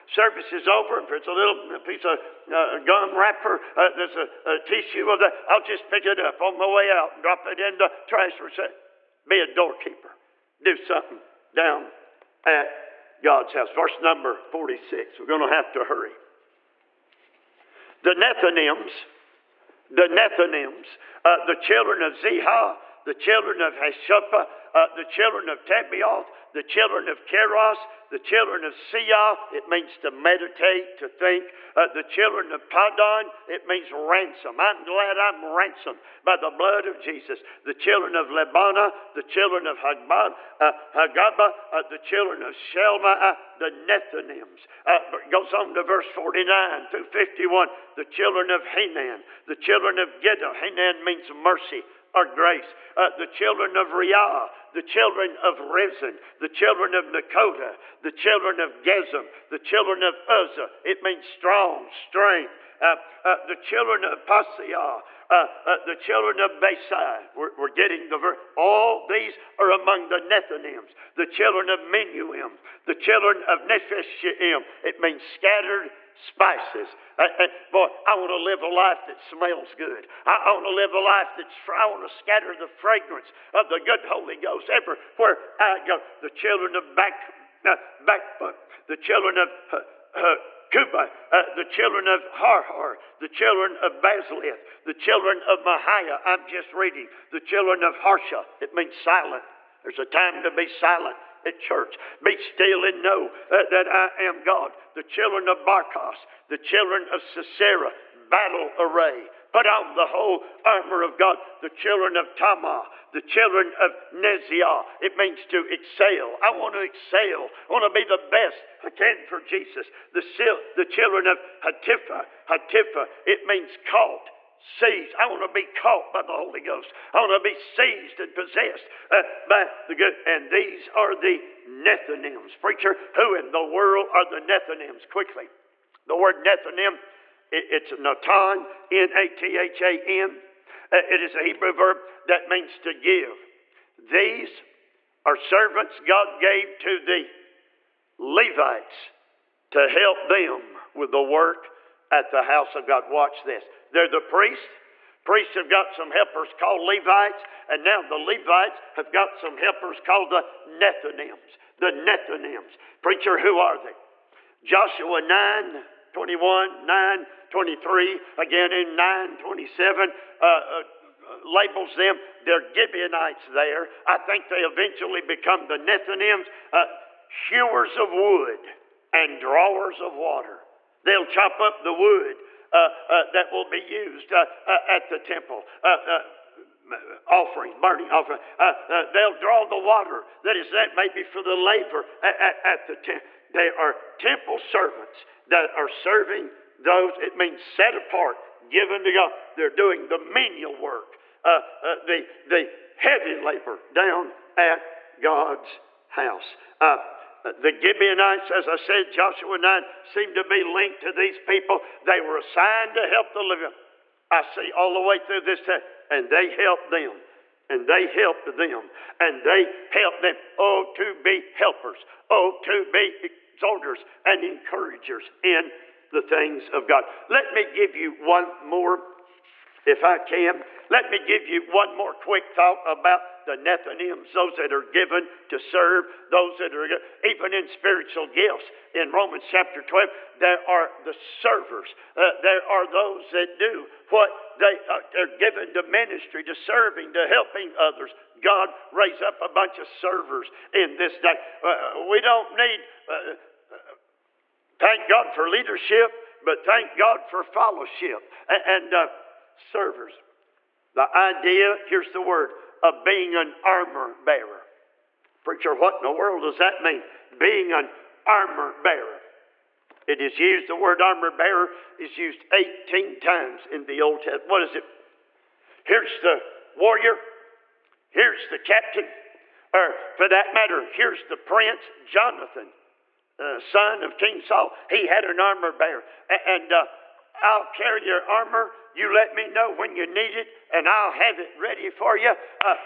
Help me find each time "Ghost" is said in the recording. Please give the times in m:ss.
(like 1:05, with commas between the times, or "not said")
1:24, 2:06.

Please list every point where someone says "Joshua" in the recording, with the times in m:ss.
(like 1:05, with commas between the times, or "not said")
2:44, 3:29.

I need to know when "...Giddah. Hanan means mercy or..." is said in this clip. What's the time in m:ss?
0:50.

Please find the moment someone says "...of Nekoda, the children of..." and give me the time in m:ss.
0:56.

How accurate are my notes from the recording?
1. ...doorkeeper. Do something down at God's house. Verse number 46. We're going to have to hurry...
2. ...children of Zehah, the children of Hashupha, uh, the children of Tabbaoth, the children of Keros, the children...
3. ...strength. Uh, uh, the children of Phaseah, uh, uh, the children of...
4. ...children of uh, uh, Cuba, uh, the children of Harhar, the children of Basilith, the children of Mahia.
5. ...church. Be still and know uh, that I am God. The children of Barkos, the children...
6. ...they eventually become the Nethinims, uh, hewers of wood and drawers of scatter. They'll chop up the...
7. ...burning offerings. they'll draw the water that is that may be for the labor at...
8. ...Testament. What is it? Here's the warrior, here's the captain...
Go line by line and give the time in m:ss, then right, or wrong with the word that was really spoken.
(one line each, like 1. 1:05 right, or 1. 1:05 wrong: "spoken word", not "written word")
1. 0:09 right
2. 0:21 right
3. 1:01 right
4. 1:28 right
5. 1:41 right
6. 2:54 wrong: "water", not "scatter"
7. 3:07 right
8. 4:34 right.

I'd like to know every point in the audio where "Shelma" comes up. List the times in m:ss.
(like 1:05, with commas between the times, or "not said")
0:42.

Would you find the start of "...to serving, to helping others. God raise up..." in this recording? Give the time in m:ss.
4:06.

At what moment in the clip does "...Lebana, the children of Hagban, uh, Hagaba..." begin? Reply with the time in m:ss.
0:38.